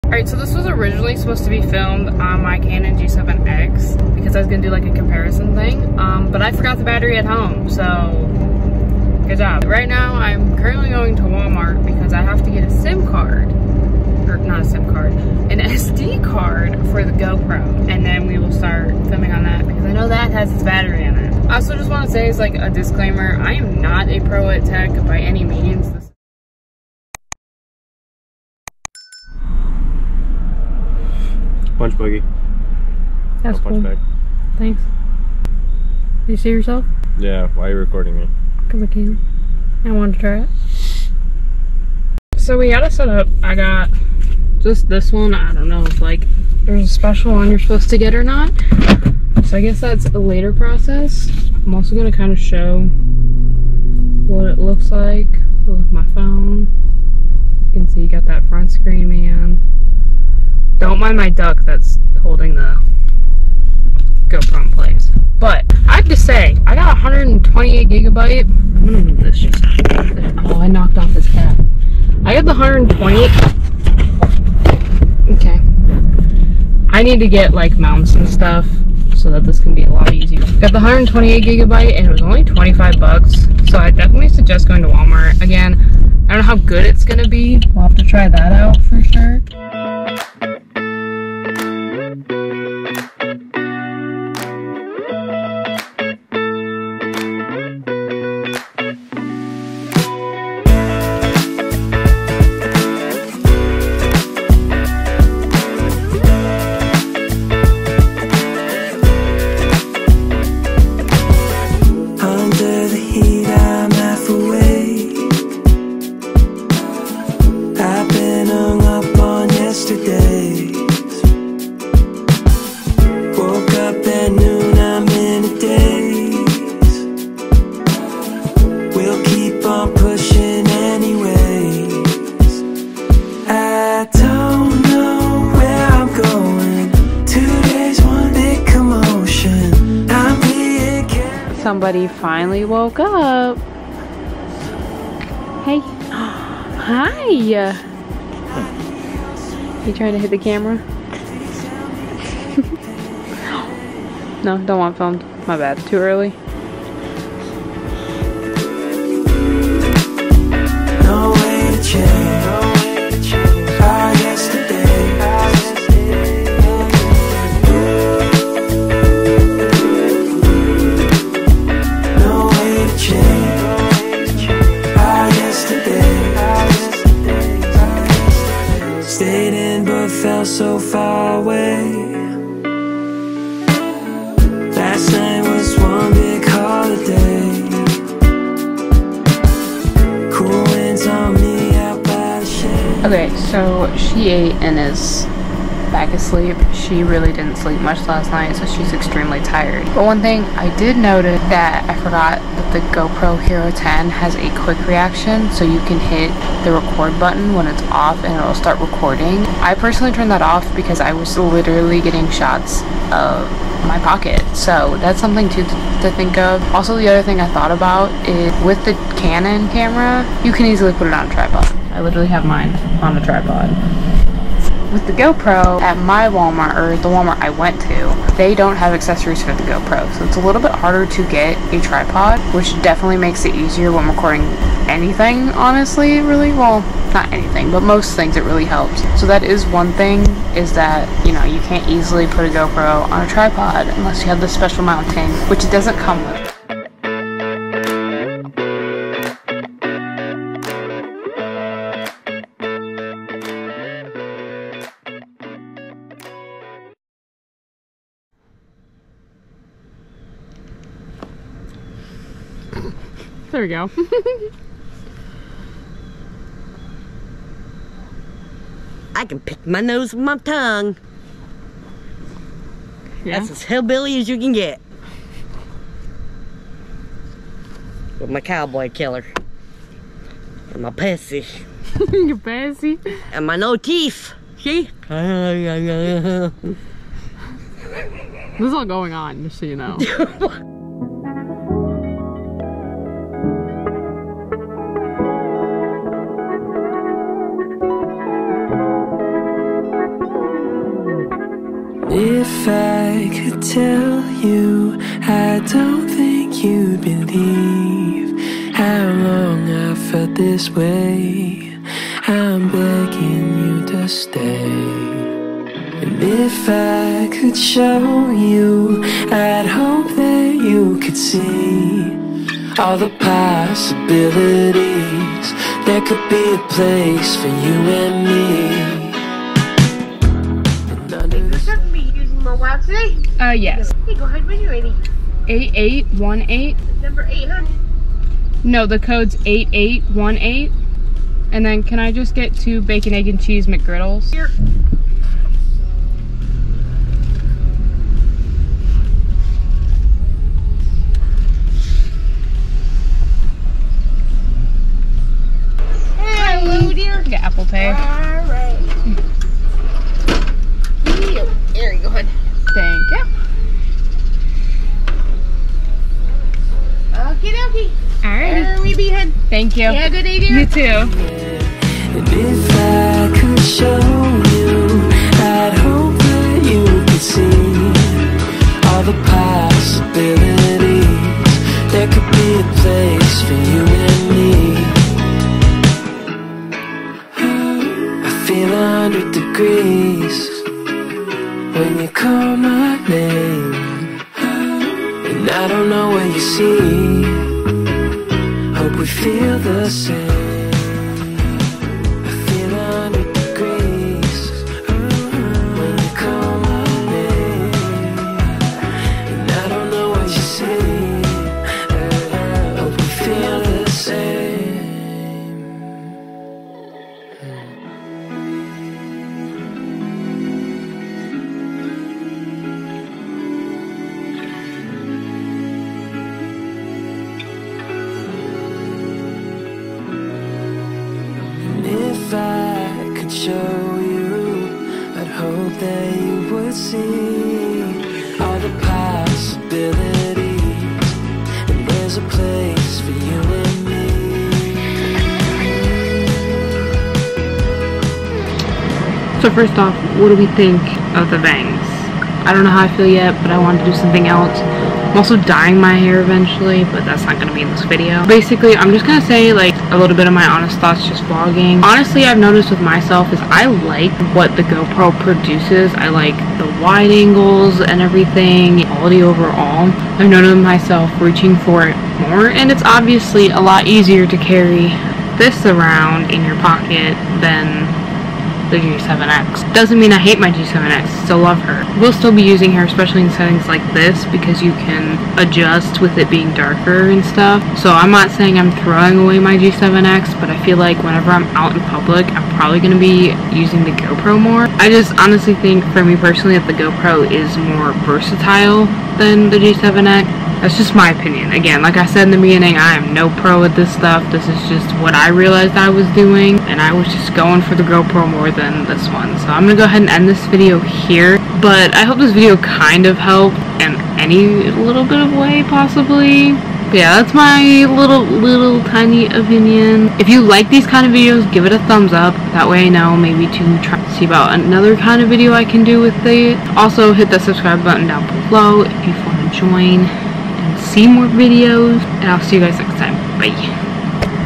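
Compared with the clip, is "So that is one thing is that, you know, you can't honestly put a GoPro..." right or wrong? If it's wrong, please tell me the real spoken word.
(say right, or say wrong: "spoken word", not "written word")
wrong: "easily", not "honestly".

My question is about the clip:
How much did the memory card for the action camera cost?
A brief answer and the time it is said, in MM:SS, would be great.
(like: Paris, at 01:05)
25 dollars, at 01:22.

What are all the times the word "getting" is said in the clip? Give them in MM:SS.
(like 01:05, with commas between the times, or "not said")
03:31.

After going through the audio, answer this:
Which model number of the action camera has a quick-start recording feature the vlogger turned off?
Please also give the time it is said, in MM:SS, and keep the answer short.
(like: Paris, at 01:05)
Hero 10, at 03:23.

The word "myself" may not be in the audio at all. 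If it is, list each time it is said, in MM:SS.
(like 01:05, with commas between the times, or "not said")
07:42, 07:50.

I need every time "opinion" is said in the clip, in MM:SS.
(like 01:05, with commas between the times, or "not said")
08:21, 08:39.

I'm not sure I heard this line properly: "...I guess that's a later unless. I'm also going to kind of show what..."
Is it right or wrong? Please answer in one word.
wrong.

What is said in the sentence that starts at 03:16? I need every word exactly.
She really didn't sleep much last night, so she's extremely tired.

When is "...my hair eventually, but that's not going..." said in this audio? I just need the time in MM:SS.
07:35.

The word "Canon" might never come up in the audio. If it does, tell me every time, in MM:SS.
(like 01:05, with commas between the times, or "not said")
00:02, 03:39.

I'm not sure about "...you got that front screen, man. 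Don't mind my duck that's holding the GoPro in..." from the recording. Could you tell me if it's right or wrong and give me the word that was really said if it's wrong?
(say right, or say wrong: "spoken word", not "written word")
right.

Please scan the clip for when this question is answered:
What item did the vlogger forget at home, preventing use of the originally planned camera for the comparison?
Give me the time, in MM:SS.
00:06.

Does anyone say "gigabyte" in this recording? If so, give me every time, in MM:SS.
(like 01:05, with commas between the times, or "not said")
01:07, 01:21.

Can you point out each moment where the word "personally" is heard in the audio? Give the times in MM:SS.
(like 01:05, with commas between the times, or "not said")
03:29, 08:16.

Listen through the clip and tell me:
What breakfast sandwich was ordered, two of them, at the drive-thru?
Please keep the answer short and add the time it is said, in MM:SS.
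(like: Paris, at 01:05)
Bacon, egg, and cheese McGriddles, at 05:42.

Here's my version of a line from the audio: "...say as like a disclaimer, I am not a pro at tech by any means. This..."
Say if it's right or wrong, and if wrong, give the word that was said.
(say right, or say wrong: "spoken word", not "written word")
right.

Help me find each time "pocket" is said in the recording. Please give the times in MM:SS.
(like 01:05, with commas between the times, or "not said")
03:34, 07:56.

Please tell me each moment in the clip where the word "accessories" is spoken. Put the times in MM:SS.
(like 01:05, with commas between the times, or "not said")
03:48.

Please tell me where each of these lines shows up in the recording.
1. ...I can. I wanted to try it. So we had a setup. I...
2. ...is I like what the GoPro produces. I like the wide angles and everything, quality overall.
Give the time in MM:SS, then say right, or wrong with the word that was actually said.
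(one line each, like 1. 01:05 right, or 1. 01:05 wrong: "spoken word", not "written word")
1. 00:38 right
2. 07:43 right.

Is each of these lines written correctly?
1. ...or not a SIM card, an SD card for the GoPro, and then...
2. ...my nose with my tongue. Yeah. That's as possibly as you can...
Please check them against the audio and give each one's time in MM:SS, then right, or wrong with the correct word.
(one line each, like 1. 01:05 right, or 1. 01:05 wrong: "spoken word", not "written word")
1. 00:14 right
2. 04:29 wrong: "hillbilly", not "possibly".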